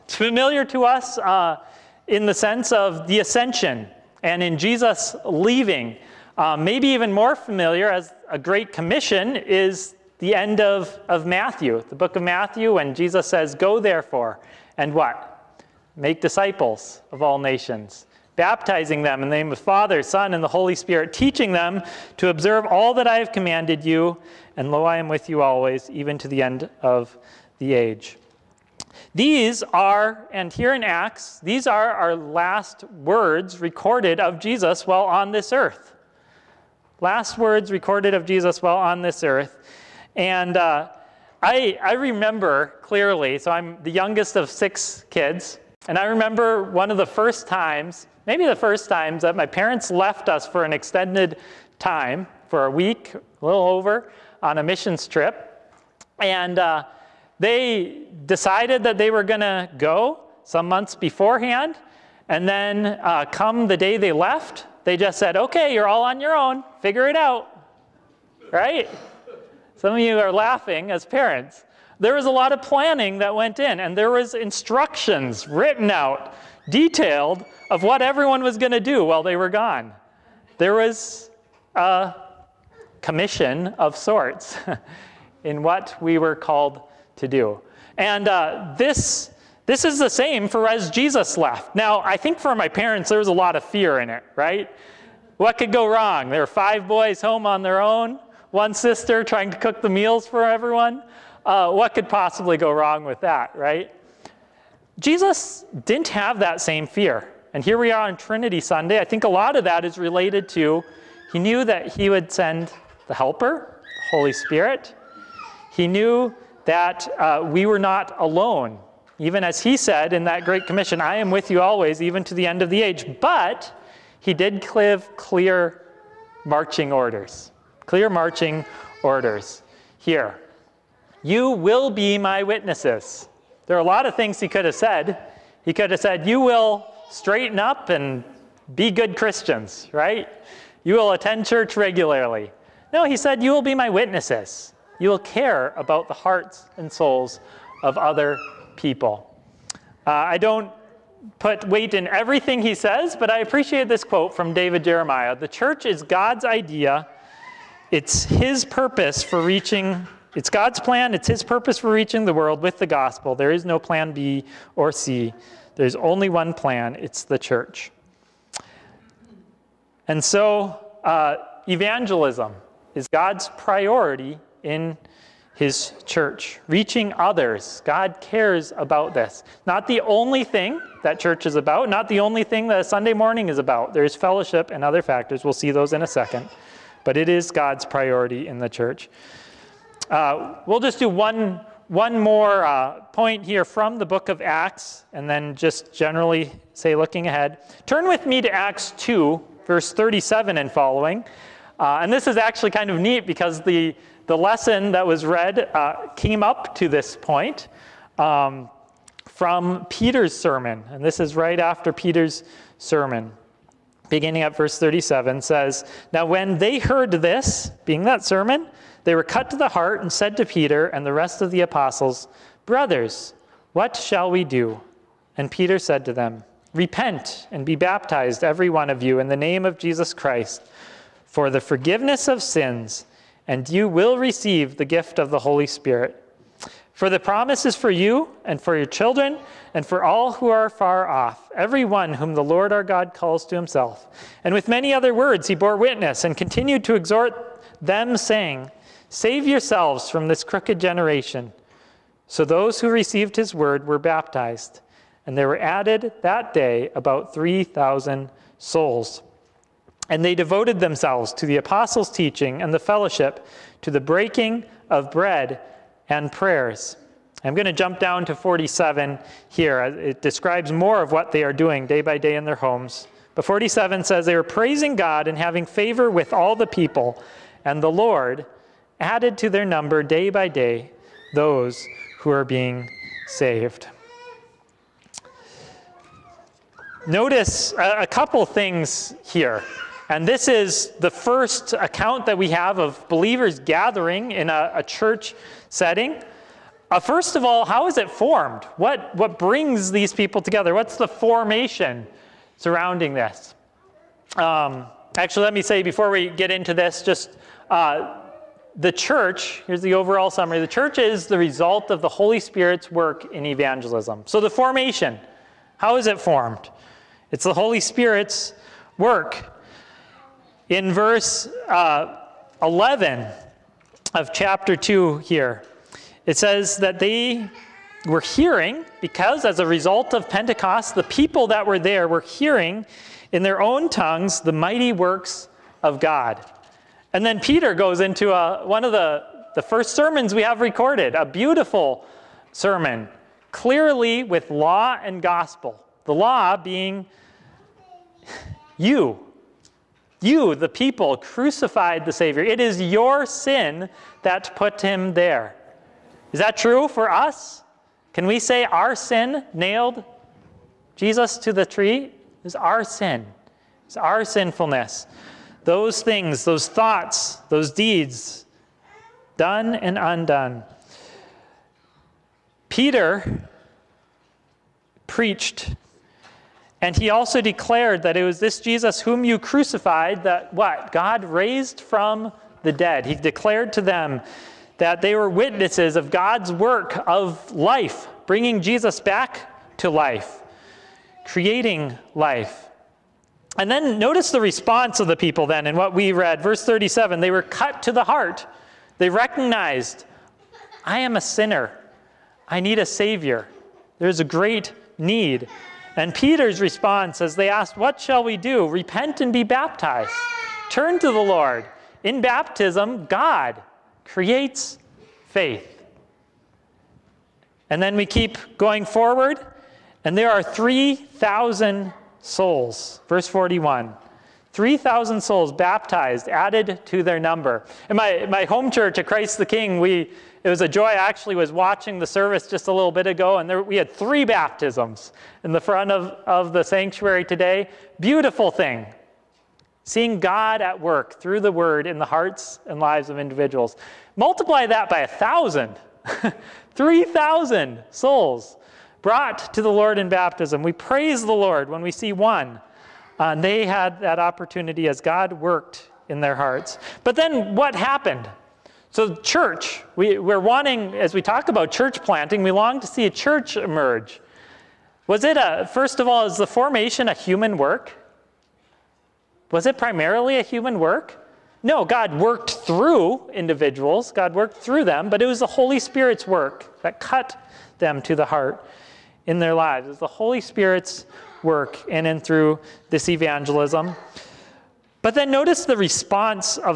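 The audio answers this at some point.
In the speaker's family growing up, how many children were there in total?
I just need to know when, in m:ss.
0:44.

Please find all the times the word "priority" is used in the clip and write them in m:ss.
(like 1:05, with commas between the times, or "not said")
2:53, 3:07.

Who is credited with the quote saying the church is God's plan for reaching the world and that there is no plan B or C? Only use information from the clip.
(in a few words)
David Jeremiah.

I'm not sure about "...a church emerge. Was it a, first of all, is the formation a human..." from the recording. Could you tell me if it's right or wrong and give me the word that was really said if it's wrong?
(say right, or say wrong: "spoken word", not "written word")
right.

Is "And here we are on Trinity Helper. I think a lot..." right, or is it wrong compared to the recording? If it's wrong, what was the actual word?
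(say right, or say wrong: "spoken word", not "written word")
wrong: "Sunday", not "Helper".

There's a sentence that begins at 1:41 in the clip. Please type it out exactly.
Uh, what could possibly go wrong with that, right?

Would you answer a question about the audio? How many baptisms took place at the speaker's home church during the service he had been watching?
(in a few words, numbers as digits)
3.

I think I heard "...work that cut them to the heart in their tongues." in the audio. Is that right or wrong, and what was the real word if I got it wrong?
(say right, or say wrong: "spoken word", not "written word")
wrong: "lives", not "tongues".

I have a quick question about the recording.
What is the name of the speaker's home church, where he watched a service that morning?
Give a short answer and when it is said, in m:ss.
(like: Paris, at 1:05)
Christ the King, at 7:09.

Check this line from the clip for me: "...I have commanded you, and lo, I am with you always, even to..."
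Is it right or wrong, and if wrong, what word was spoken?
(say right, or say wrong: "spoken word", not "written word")
right.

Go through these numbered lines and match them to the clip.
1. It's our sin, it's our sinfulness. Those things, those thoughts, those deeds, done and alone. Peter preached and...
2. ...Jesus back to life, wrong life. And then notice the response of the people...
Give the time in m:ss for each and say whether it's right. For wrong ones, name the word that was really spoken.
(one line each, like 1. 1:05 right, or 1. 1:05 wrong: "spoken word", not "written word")
1. 6:02 wrong: "undone", not "alone"
2. 6:28 wrong: "creating", not "wrong".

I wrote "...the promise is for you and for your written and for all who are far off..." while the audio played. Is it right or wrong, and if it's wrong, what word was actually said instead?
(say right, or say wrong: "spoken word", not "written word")
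wrong: "children", not "written".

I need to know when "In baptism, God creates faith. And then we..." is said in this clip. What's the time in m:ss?
6:52.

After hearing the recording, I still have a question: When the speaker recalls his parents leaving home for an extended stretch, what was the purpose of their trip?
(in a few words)
a missions trip.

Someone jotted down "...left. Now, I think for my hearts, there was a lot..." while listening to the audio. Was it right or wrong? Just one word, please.
wrong.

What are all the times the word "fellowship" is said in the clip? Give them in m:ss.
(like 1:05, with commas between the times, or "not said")
3:04, 4:22.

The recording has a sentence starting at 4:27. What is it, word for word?
I'm going to jump down to 47 here.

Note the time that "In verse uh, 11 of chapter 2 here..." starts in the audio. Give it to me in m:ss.
5:20.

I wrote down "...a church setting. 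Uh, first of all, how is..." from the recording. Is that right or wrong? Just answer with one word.
right.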